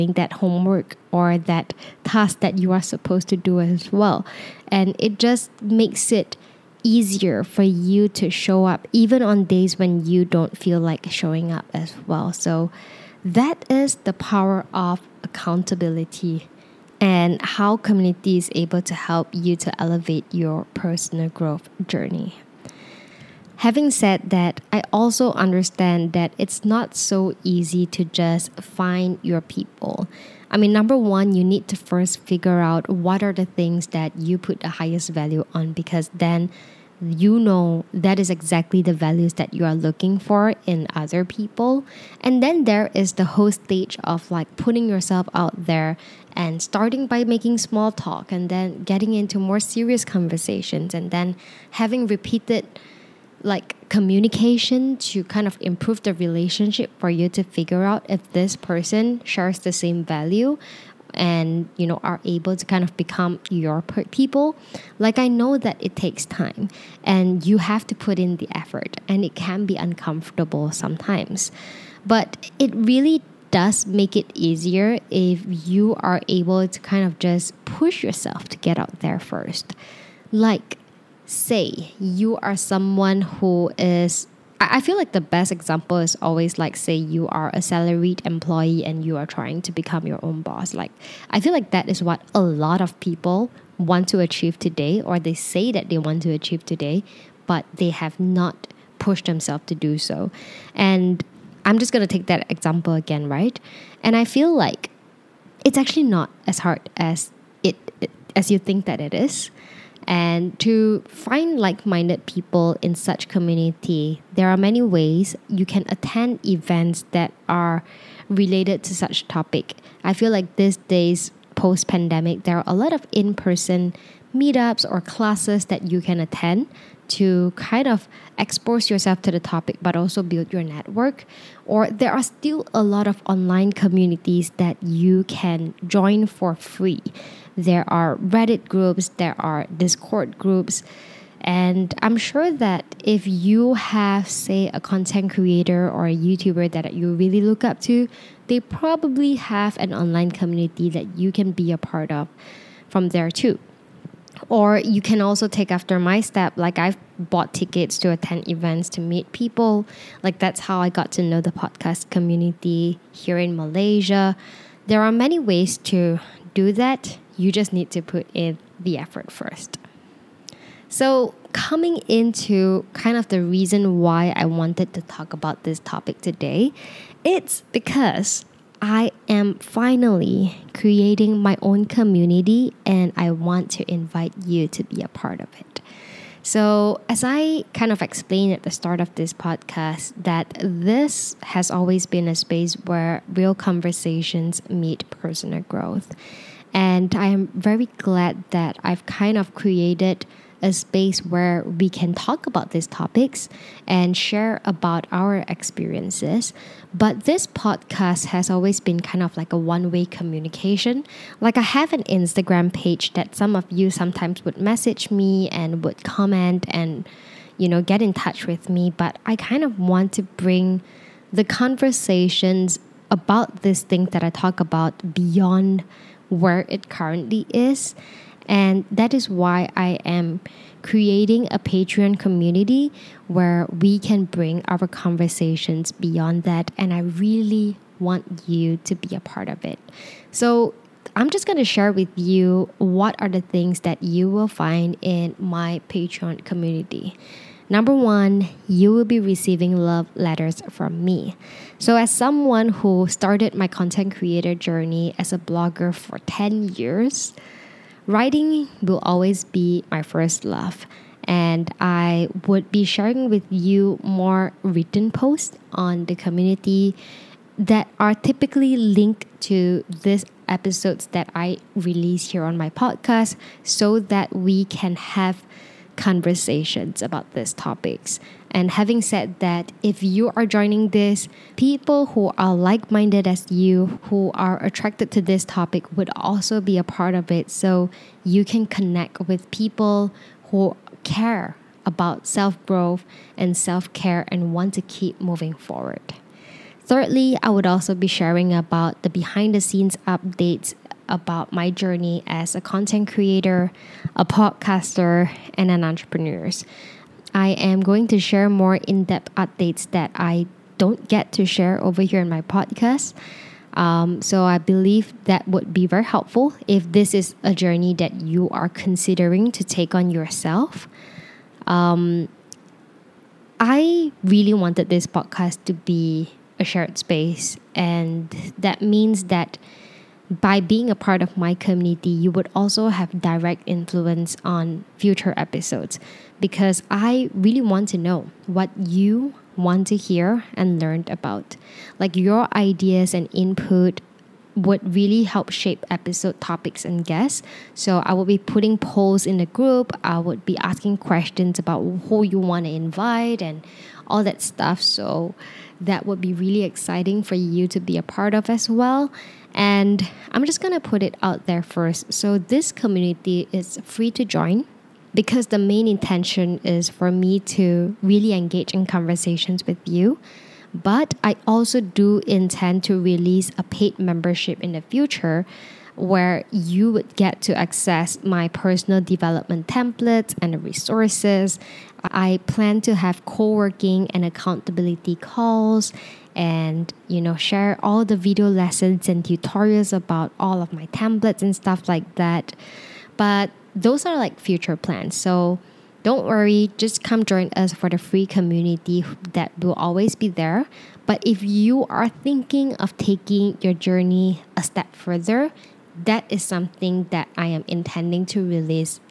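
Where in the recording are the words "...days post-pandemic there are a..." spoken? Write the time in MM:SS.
02:00.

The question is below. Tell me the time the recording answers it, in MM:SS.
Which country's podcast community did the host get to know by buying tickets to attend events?
02:43.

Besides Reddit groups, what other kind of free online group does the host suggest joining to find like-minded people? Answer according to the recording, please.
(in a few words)
Discord groups.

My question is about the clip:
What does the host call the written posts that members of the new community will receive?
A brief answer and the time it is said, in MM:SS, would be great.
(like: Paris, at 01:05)
Love letters, at 04:09.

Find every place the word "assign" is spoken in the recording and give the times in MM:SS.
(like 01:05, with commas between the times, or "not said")
not said.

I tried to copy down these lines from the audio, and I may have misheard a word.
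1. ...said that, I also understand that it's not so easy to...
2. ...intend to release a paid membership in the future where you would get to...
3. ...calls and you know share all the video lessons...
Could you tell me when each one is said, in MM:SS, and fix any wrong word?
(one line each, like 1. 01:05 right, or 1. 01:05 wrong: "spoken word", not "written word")
1. 00:23 right
2. 06:12 right
3. 06:25 right.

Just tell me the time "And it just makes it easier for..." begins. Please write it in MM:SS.
00:04.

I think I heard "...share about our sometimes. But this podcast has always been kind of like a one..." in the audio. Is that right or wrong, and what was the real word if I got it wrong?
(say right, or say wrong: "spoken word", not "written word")
wrong: "experiences", not "sometimes".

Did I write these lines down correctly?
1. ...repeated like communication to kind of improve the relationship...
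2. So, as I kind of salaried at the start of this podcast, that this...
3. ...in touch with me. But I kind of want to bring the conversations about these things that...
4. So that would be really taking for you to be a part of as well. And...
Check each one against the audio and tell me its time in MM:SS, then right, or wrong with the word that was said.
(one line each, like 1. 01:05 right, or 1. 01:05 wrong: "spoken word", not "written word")
1. 00:52 right
2. 03:06 wrong: "explained", not "salaried"
3. 03:37 right
4. 05:54 wrong: "exciting", not "taking".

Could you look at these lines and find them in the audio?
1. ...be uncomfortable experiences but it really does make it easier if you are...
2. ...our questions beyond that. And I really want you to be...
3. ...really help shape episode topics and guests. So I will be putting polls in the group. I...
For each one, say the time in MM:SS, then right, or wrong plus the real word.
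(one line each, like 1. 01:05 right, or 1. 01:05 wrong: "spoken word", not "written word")
1. 01:09 wrong: "sometimes", not "experiences"
2. 03:54 wrong: "conversations", not "questions"
3. 05:44 right.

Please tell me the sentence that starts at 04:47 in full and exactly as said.
So you can connect with people who care about self growth and self care and want to keep moving forward.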